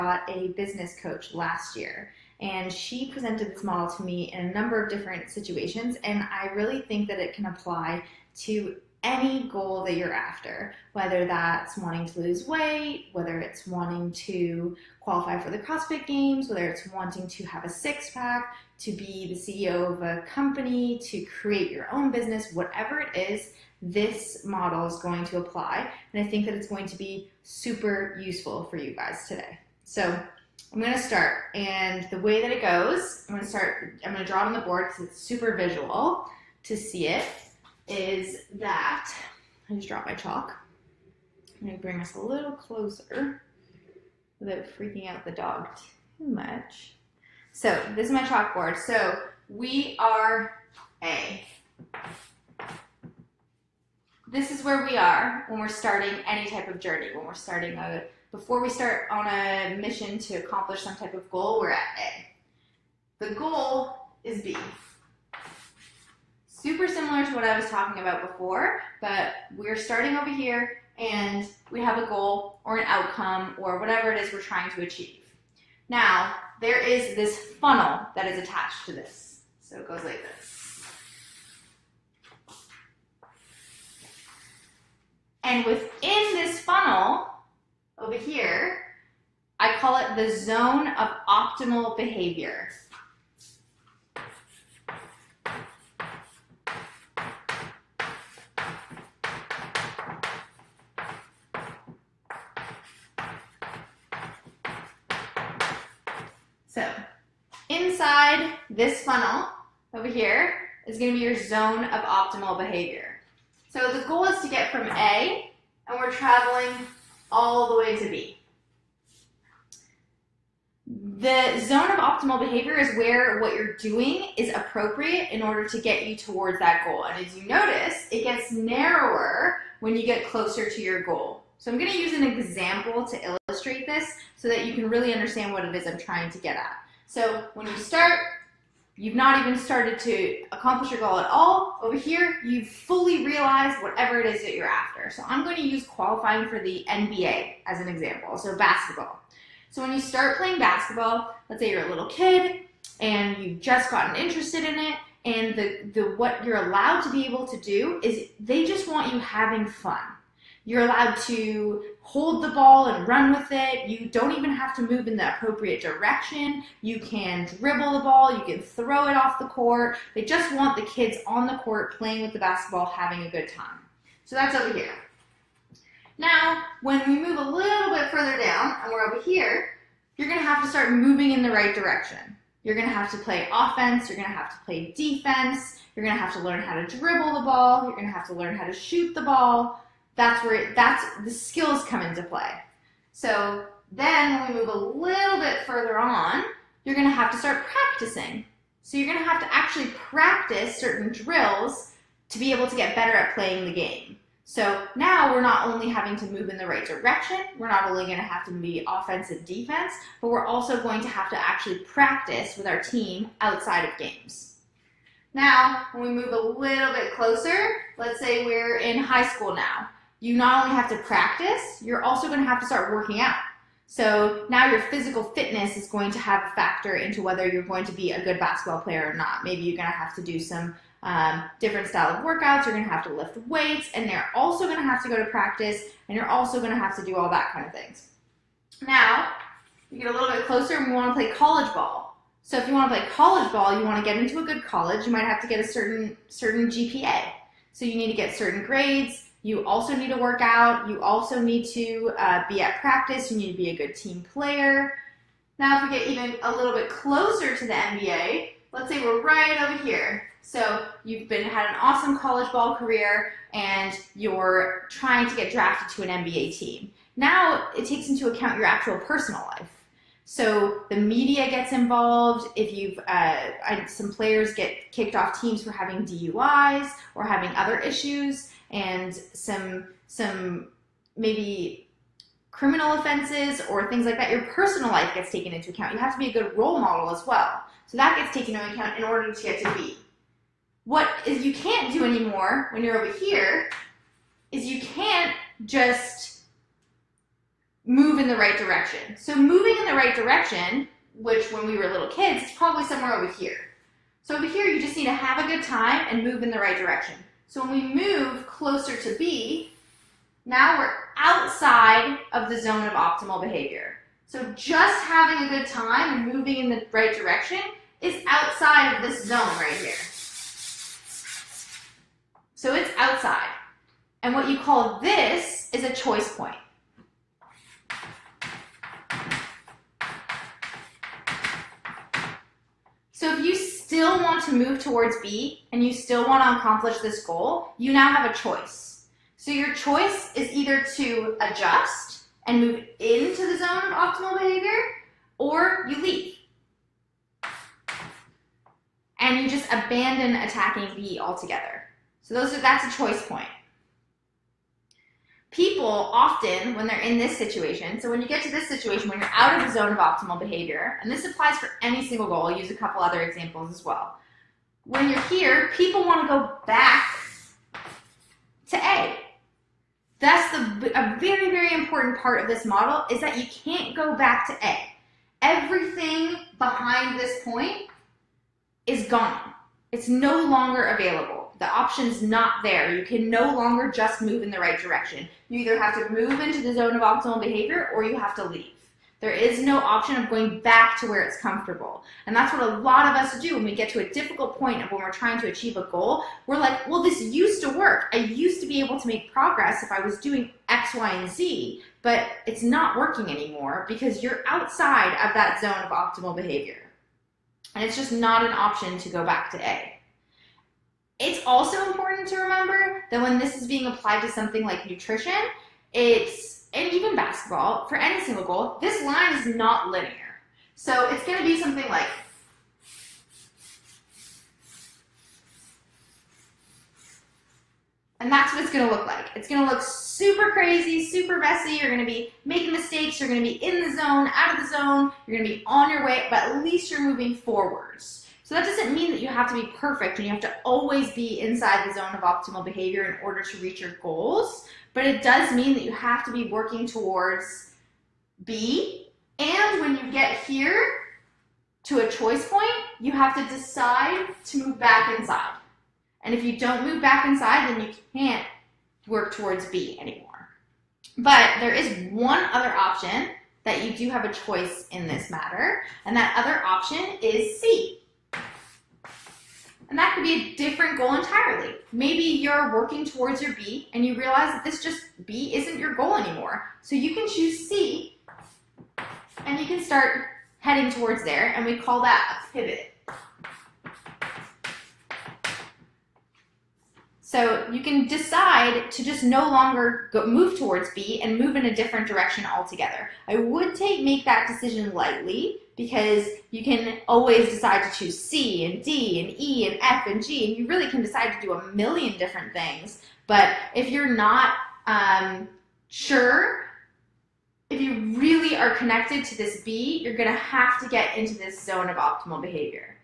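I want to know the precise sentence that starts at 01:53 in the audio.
So the goal is to get from A, and we're traveling all the way to B.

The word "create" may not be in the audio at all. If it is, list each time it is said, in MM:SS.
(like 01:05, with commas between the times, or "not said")
00:21.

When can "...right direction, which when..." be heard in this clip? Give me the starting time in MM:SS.
04:59.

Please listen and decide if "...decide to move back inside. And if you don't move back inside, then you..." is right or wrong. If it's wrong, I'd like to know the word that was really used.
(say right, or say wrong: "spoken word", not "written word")
right.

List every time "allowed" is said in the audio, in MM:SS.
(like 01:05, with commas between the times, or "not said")
02:36, 02:40.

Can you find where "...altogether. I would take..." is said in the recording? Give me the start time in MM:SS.
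08:12.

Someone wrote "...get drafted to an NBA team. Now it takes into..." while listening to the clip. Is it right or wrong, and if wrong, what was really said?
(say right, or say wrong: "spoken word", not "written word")
right.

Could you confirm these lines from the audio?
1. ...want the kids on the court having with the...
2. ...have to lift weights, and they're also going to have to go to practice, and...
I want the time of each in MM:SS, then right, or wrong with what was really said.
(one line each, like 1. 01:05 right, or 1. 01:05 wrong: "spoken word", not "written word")
1. 02:50 wrong: "playing", not "having"
2. 03:52 right.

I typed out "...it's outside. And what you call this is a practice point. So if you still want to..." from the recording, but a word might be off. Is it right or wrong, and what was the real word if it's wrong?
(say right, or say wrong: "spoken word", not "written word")
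wrong: "choice", not "practice".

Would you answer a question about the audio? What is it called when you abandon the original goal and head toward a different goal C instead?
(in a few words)
A pivot.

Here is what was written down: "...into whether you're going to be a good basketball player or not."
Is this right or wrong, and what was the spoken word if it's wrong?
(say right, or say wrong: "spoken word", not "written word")
right.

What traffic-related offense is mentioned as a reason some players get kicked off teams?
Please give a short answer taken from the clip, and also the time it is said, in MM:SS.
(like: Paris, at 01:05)
DUIs, at 04:36.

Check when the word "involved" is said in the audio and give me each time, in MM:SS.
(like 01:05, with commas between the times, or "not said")
04:31.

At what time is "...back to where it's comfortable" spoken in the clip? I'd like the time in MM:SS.
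06:30.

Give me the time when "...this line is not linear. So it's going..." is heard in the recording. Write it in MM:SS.
06:58.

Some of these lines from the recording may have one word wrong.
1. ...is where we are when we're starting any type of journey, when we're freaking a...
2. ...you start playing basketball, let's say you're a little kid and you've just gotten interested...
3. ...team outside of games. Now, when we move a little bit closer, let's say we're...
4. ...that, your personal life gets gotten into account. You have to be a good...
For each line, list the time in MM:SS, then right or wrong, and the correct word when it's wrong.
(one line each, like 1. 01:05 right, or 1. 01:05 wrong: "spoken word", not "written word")
1. 00:54 wrong: "starting", not "freaking"
2. 02:29 right
3. 03:32 right
4. 04:44 wrong: "taken", not "gotten".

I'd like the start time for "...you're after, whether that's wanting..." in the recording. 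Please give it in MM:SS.
00:09.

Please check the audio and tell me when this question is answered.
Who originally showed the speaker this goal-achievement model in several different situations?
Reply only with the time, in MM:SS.
00:00.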